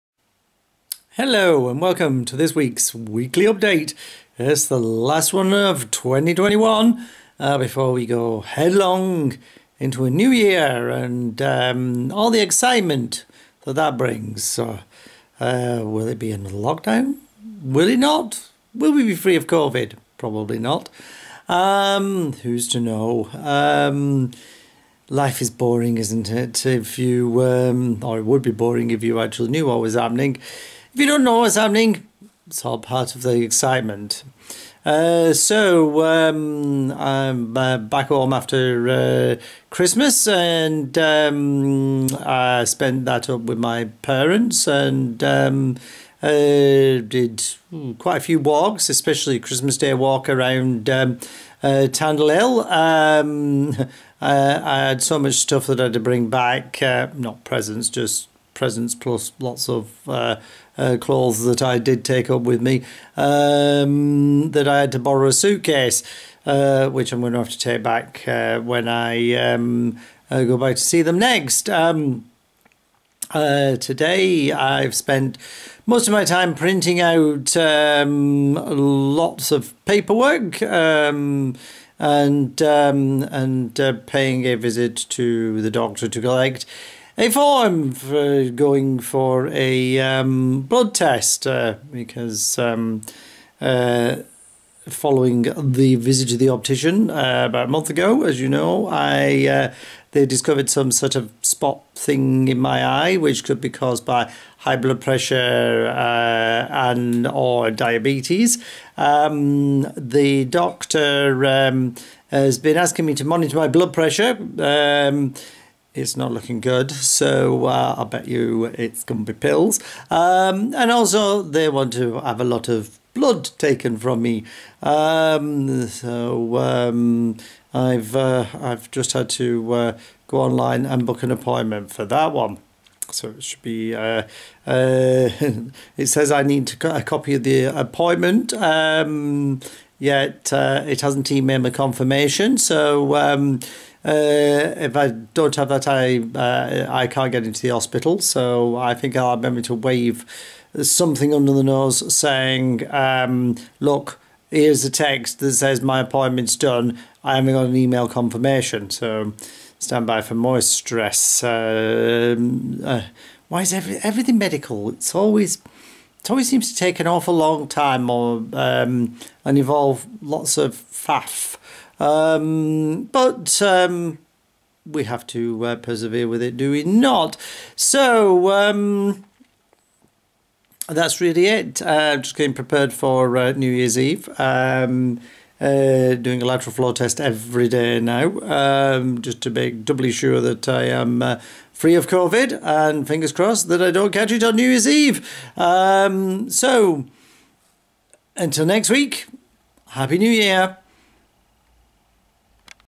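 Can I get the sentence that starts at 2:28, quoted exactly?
So I think I'll remember to wave something under the nose saying, um, "Look, here's a text that says my appointment's done.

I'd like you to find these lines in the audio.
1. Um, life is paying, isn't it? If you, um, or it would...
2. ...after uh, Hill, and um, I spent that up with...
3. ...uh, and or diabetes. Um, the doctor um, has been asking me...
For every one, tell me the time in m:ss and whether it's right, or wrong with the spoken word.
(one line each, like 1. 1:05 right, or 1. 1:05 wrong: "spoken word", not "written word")
1. 0:23 wrong: "boring", not "paying"
2. 0:38 wrong: "Christmas", not "Hill"
3. 1:45 right.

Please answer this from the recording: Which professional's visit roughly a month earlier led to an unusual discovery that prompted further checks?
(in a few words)
the optician.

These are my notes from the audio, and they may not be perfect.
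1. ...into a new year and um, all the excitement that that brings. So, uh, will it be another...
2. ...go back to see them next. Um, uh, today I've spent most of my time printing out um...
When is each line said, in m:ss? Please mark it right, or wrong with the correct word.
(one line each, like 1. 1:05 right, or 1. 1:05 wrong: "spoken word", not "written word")
1. 0:09 right
2. 1:10 right.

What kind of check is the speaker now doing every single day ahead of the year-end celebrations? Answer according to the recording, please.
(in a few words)
lateral flow test.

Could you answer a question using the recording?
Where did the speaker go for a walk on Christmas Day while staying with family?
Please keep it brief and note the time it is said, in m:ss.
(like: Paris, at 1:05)
Tandle Hill, at 0:51.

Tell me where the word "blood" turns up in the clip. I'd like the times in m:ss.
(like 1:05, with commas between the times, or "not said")
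1:30, 1:44, 1:53, 2:03.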